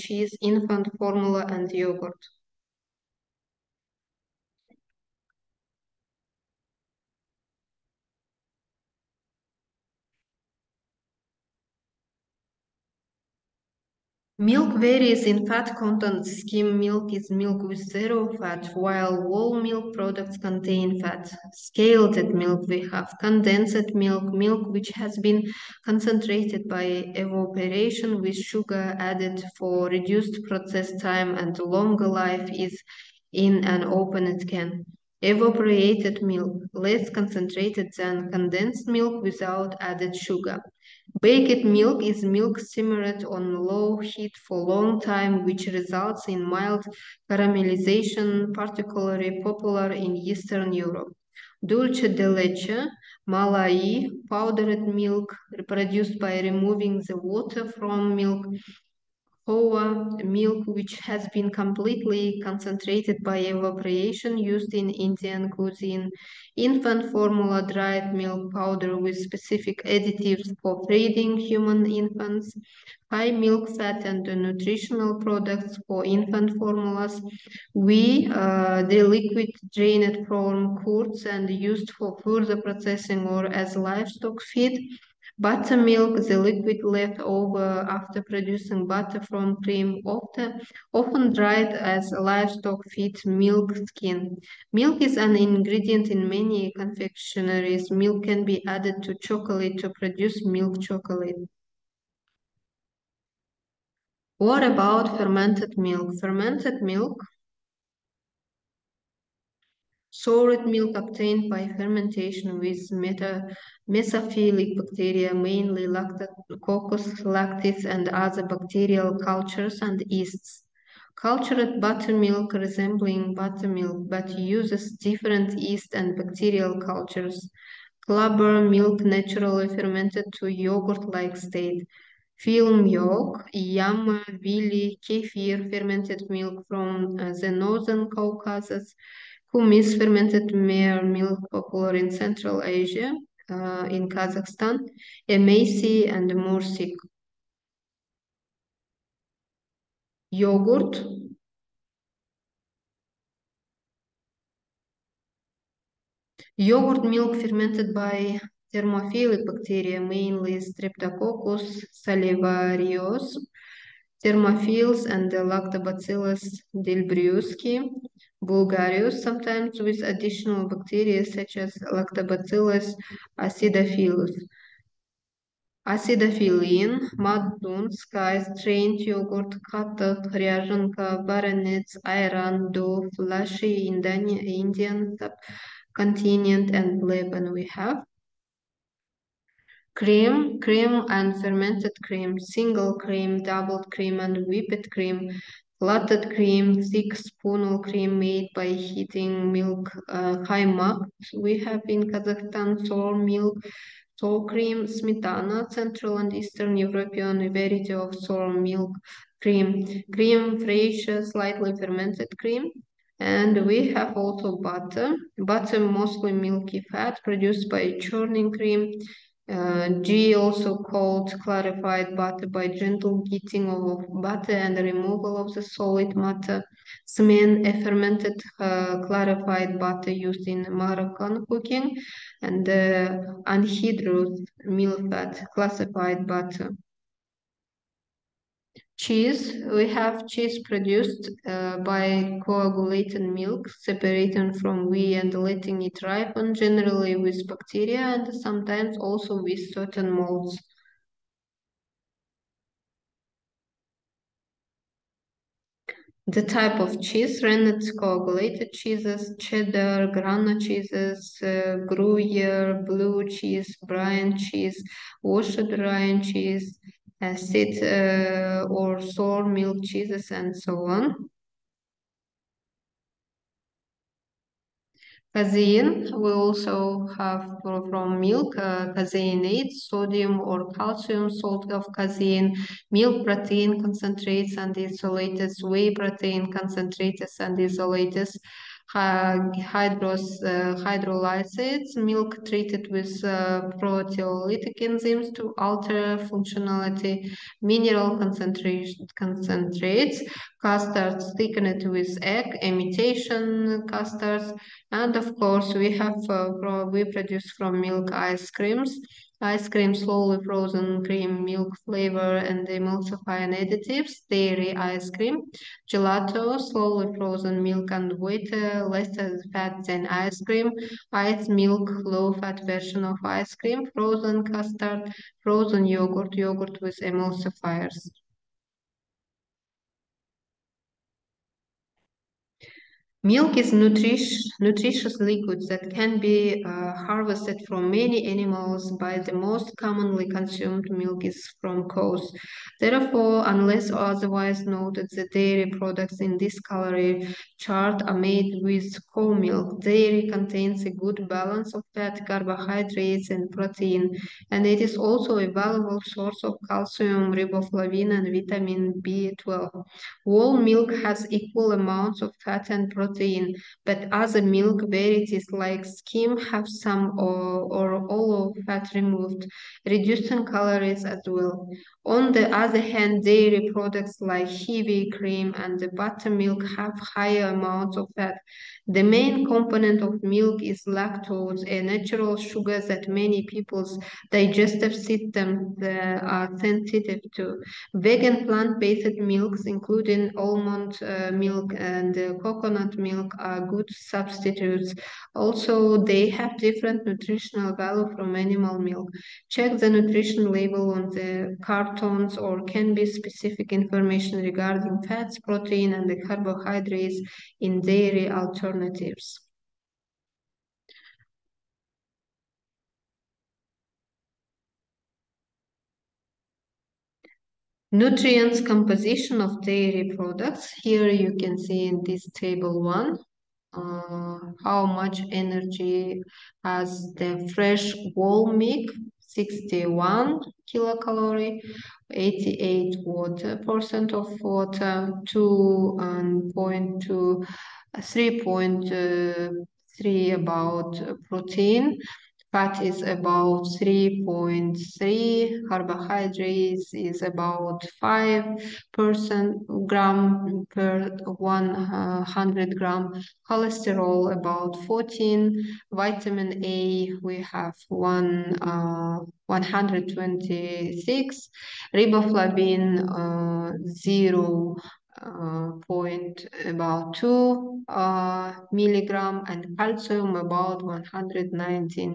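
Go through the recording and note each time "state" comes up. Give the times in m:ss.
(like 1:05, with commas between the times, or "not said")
2:11.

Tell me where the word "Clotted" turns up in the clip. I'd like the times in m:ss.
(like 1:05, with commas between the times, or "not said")
3:15.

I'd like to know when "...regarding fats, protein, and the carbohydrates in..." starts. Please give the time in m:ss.
6:44.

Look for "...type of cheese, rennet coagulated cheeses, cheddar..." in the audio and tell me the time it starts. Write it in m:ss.
4:16.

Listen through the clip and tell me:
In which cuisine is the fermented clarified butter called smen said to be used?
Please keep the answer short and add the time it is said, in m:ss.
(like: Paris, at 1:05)
Moroccan cooking, at 3:50.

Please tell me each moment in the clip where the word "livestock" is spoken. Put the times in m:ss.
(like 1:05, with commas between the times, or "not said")
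1:23, 1:32.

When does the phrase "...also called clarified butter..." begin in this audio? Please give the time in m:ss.
3:40.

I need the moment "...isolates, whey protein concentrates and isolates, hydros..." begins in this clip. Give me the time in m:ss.
4:44.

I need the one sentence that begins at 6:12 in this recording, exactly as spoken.
On the other hand, dairy products like heavy cream and the buttermilk have higher amounts of fat.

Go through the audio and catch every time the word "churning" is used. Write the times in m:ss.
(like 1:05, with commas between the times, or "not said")
3:38.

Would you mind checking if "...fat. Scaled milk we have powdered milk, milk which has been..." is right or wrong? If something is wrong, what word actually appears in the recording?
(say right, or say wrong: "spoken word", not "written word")
wrong: "condensed", not "powdered".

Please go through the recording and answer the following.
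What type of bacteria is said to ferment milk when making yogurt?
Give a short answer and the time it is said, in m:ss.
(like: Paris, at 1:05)
thermophilic bacteria, at 2:38.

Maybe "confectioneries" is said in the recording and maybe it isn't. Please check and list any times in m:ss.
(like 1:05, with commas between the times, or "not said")
1:36.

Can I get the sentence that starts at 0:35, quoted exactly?
Evaporated milk, less concentrated than condensed milk without added sugar.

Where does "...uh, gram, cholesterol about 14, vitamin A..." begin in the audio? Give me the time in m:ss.
7:32.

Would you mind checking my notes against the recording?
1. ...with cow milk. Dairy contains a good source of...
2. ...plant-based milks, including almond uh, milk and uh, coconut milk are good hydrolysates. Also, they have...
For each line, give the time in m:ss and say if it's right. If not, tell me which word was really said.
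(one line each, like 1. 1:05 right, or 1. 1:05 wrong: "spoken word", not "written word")
1. 5:48 wrong: "balance", not "source"
2. 6:28 wrong: "substitutes", not "hydrolysates".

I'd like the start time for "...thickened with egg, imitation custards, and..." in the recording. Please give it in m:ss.
5:01.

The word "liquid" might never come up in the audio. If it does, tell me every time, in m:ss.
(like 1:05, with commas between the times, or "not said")
1:19, 1:26, 5:35.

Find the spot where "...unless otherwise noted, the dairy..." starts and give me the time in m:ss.
5:43.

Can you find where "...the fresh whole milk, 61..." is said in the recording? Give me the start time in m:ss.
7:07.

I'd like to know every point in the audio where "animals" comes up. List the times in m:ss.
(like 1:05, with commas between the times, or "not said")
5:38, 6:38.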